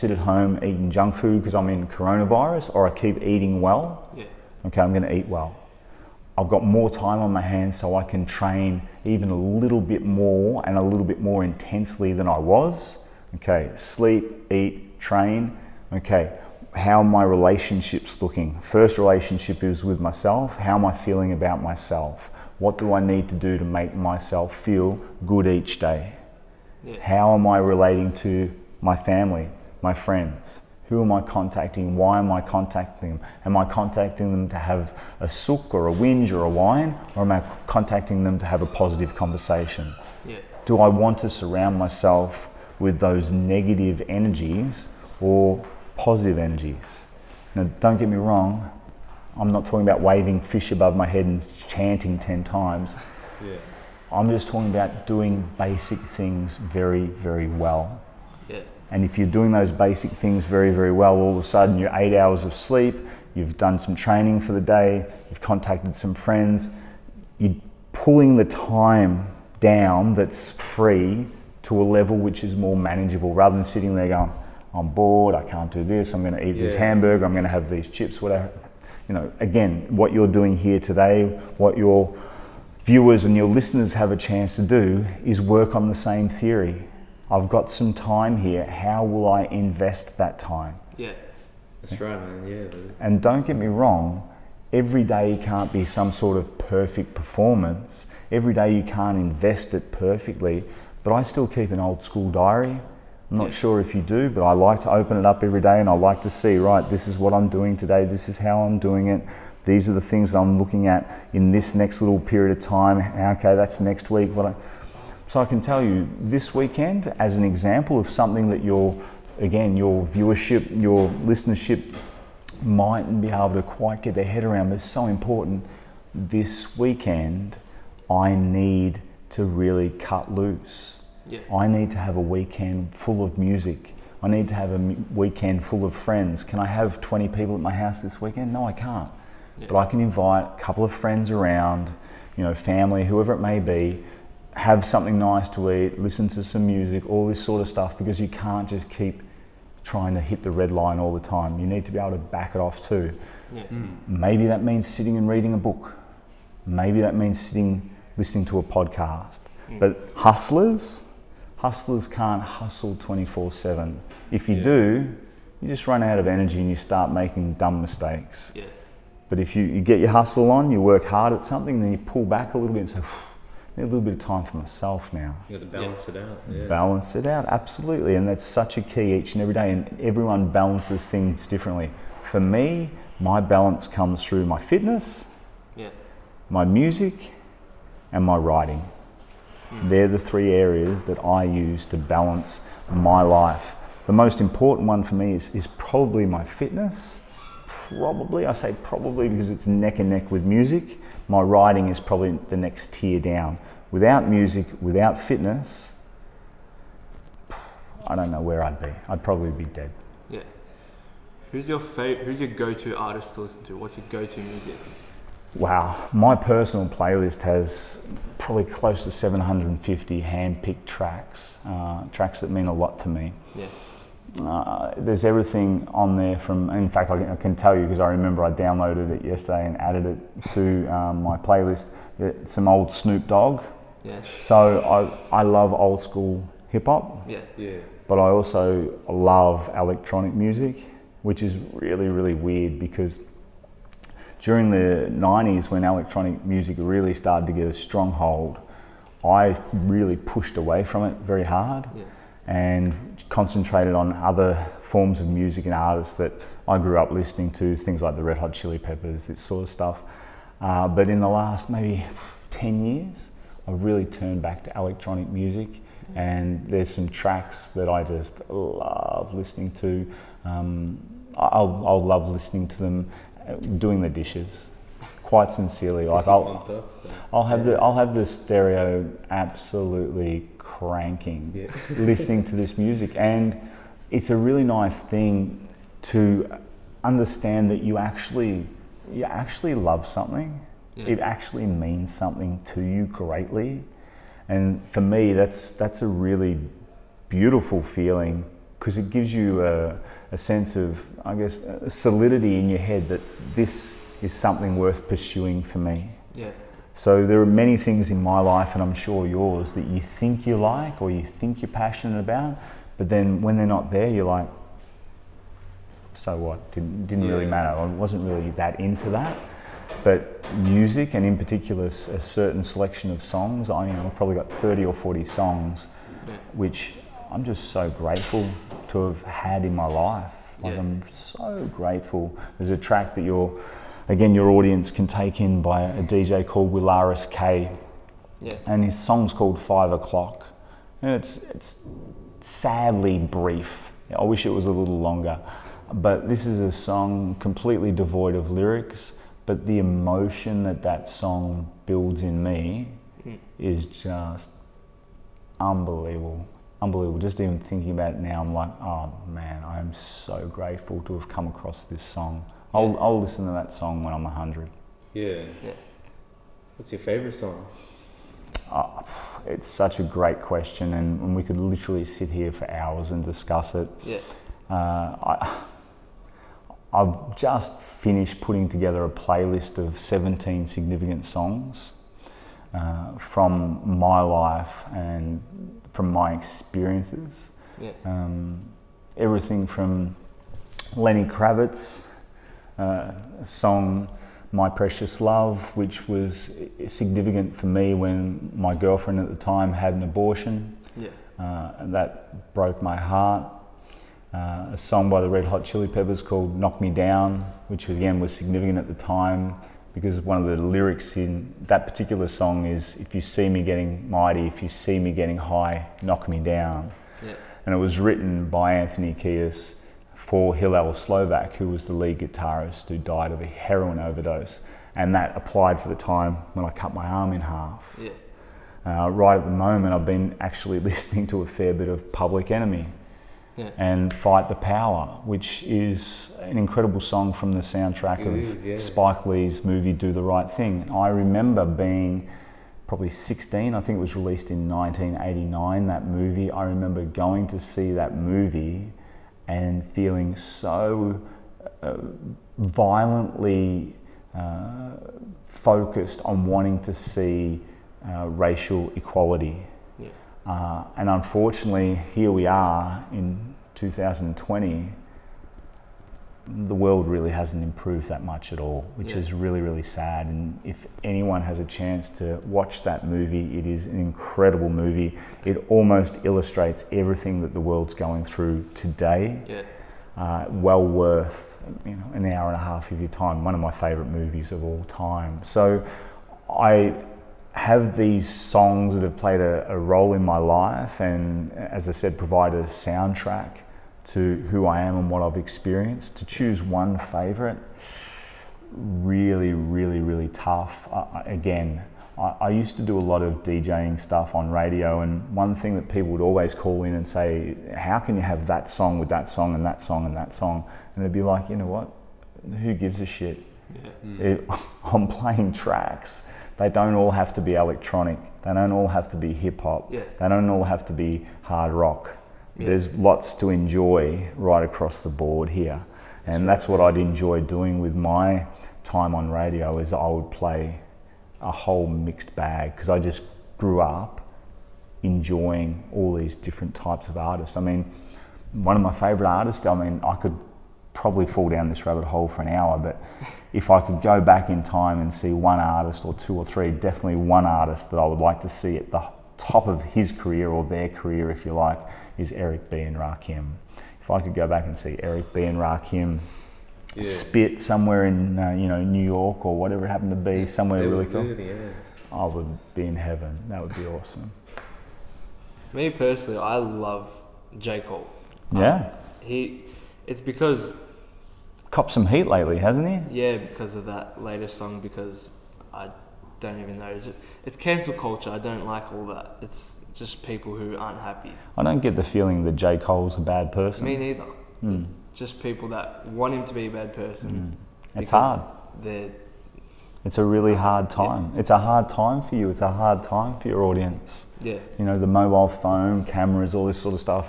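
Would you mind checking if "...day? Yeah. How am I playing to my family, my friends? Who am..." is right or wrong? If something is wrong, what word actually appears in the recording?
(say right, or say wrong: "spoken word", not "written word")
wrong: "relating", not "playing".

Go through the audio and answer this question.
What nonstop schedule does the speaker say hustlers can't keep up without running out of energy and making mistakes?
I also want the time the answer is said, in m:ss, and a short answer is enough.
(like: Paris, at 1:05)
24/7, at 2:42.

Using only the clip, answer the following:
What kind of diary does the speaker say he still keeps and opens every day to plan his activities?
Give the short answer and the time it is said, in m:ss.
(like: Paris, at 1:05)
old school diary, at 1:41.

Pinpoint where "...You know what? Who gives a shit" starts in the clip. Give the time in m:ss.
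8:31.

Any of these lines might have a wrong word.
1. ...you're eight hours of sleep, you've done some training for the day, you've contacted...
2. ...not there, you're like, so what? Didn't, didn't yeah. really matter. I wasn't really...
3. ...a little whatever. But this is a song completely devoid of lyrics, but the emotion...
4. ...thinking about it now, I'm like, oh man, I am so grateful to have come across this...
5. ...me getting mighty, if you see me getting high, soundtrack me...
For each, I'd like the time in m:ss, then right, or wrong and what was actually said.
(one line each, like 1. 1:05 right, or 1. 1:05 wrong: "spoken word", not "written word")
1. 1:01 right
2. 5:13 right
3. 5:44 wrong: "longer", not "whatever"
4. 5:57 right
5. 6:53 wrong: "knock", not "soundtrack".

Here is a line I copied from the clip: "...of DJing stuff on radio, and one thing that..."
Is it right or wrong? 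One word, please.
right.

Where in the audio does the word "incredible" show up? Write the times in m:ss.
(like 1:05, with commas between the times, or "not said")
7:16, 7:53.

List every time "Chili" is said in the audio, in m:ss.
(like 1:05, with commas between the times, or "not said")
4:18, 6:45.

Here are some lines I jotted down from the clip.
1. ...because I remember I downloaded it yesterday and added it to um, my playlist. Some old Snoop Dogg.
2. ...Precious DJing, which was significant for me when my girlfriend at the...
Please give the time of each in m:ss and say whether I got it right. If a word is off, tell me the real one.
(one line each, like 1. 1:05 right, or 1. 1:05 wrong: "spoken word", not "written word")
1. 3:47 right
2. 6:34 wrong: "Love", not "DJing".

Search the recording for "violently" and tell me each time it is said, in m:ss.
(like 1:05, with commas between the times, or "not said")
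7:32.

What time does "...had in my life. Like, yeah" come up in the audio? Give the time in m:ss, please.
5:29.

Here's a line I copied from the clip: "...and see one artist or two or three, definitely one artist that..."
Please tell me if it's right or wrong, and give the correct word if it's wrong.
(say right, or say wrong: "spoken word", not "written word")
right.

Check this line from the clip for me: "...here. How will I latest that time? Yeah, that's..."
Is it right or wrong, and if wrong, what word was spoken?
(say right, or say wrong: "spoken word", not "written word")
wrong: "invest", not "latest".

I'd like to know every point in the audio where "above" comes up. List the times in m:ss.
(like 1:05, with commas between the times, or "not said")
0:50.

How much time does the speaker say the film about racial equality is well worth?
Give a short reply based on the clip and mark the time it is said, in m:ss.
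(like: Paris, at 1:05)
an hour and a half, at 8:02.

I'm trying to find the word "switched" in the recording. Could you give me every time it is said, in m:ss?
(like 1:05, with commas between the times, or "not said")
not said.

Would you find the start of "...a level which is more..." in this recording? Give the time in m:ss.
1:11.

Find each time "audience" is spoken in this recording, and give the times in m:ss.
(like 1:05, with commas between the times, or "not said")
5:34, 9:53.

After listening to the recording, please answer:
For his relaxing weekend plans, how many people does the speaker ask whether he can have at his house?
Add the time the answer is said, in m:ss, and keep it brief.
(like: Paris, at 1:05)
20, at 2:17.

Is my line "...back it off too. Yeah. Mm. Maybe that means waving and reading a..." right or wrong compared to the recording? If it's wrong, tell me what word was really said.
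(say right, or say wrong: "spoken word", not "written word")
wrong: "sitting", not "waving".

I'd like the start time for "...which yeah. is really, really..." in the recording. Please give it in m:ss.
7:48.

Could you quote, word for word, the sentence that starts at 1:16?
this hamburger, I'm going to have these chips, whatever.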